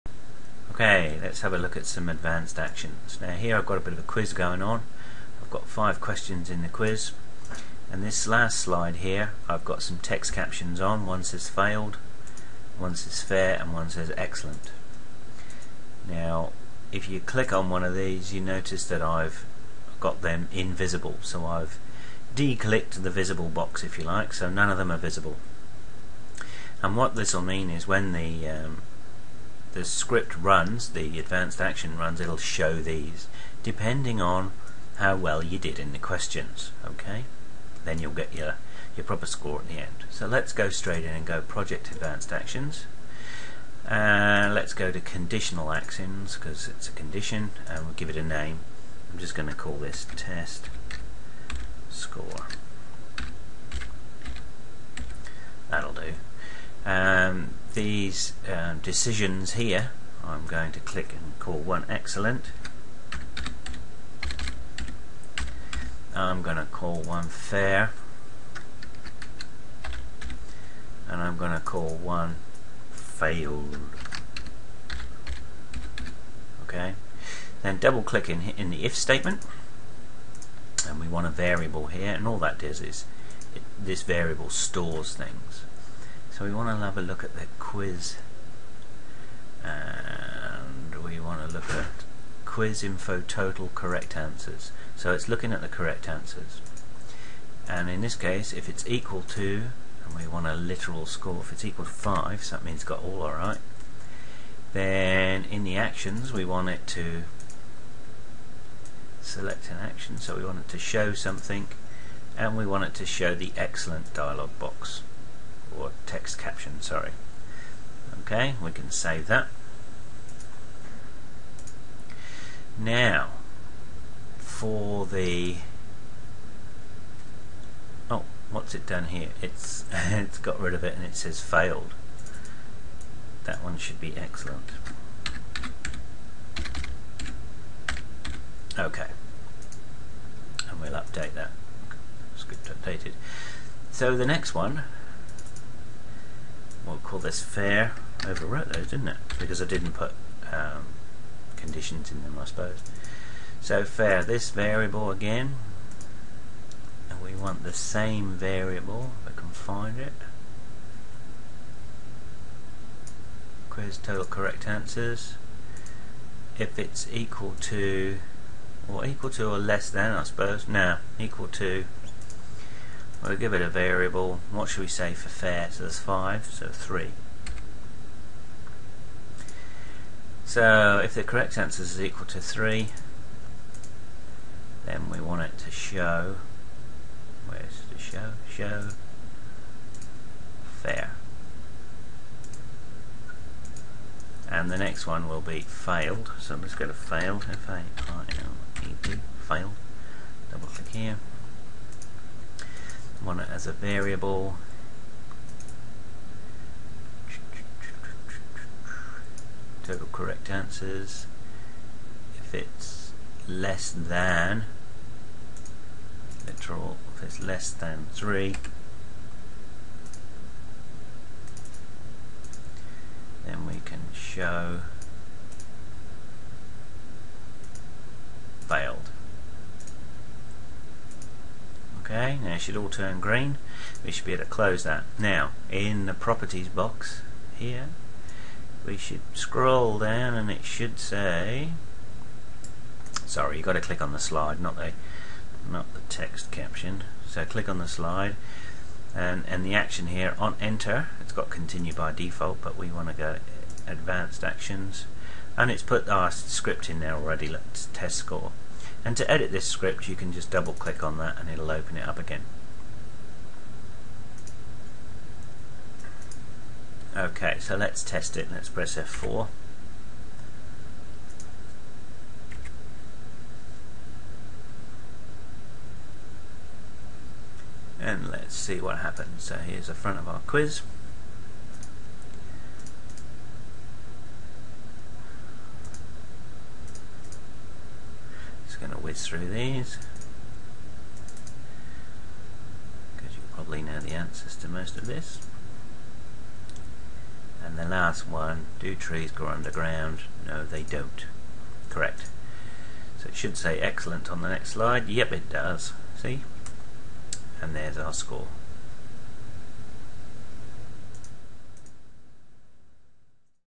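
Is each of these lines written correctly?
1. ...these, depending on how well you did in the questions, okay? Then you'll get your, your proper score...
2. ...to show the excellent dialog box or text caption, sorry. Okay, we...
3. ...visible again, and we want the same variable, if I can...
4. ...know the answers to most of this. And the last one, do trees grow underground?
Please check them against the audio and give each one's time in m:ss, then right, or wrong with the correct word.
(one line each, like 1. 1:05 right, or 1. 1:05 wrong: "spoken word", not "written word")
1. 0:32 right
2. 1:52 right
3. 2:34 wrong: "variable", not "visible"
4. 4:53 right.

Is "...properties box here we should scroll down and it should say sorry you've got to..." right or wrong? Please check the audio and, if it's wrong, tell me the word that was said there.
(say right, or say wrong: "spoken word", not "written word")
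right.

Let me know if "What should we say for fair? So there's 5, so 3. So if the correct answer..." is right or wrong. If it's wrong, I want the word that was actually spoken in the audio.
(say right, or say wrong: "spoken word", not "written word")
right.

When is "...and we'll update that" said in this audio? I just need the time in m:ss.
2:20.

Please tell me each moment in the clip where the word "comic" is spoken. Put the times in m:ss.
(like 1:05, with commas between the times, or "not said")
not said.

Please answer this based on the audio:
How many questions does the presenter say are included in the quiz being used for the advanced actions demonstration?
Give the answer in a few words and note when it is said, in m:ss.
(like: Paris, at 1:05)
5, at 0:05.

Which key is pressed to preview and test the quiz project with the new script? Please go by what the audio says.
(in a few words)
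F4.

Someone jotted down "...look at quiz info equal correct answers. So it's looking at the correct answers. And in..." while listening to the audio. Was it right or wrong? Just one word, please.
wrong.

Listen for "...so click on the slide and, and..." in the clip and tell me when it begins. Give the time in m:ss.
4:07.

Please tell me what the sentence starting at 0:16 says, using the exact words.
Now, if you click on one of these, you notice that I've got them invisible.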